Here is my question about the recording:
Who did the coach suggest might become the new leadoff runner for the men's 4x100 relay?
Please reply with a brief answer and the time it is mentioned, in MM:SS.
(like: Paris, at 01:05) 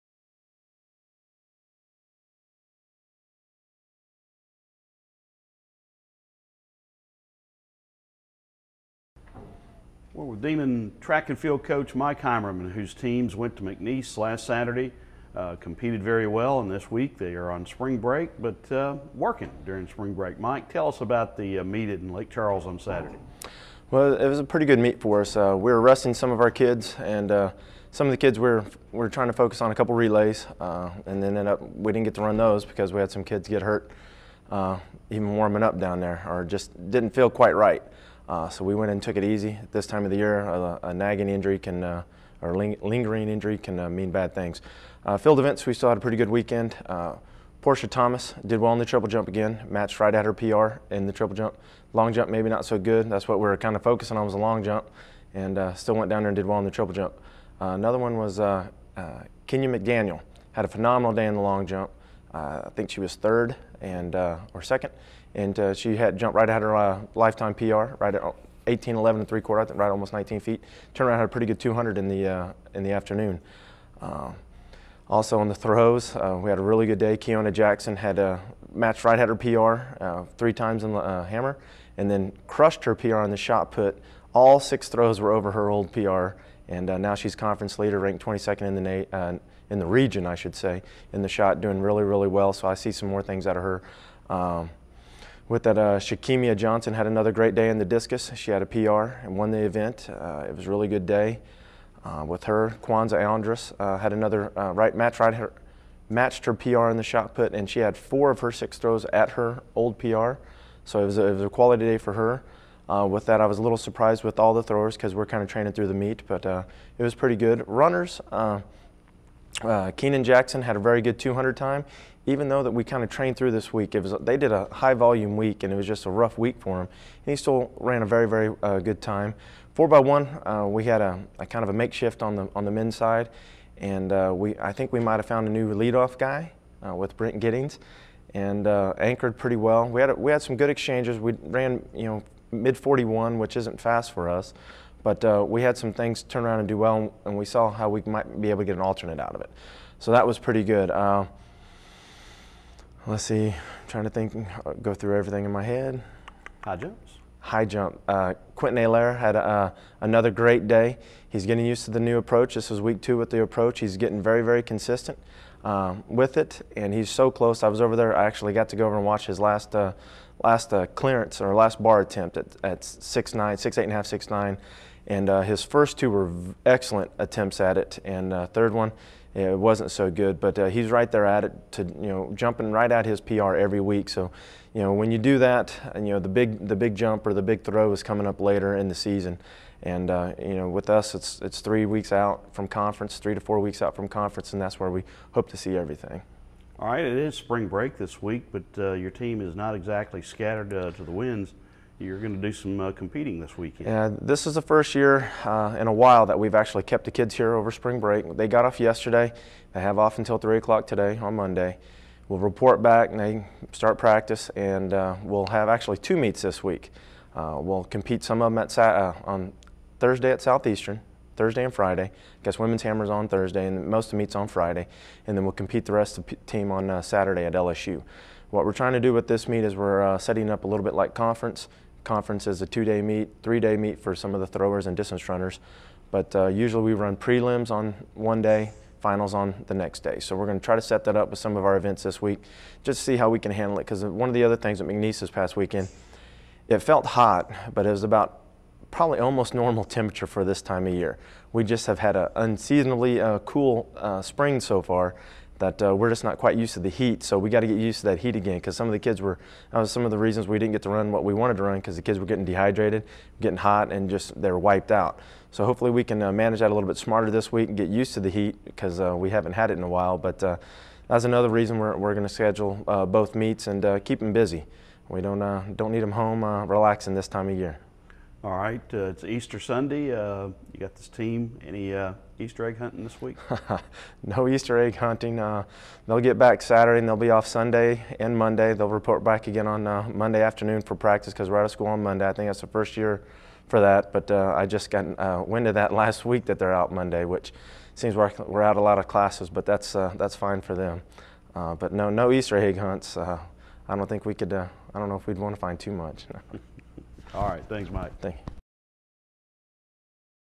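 Brent Giddings, at 02:17.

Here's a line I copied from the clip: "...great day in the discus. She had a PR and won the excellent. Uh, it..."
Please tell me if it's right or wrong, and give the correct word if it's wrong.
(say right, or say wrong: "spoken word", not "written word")
wrong: "event", not "excellent".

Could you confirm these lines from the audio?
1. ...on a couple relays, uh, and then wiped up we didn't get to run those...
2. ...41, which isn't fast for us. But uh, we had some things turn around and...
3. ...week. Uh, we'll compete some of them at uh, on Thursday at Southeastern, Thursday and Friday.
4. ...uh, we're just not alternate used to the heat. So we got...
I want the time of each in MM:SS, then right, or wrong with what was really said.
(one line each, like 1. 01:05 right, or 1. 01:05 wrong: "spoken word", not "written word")
1. 00:29 wrong: "ended", not "wiped"
2. 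02:22 right
3. 03:36 right
4. 04:15 wrong: "quite", not "alternate".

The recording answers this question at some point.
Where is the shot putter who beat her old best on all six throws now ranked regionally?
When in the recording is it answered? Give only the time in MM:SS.
01:28.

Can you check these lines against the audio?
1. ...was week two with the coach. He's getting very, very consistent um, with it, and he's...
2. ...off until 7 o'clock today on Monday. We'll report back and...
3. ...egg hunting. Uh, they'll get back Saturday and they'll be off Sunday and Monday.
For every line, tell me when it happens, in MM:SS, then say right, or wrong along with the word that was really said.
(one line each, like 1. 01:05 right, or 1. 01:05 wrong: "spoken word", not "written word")
1. 02:42 wrong: "approach", not "coach"
2. 03:29 wrong: "3", not "7"
3. 04:44 right.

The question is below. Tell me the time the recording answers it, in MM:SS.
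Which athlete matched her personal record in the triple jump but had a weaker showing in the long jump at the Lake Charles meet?
00:47.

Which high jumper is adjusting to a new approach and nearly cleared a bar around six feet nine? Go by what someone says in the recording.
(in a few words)
Quentin Allaire.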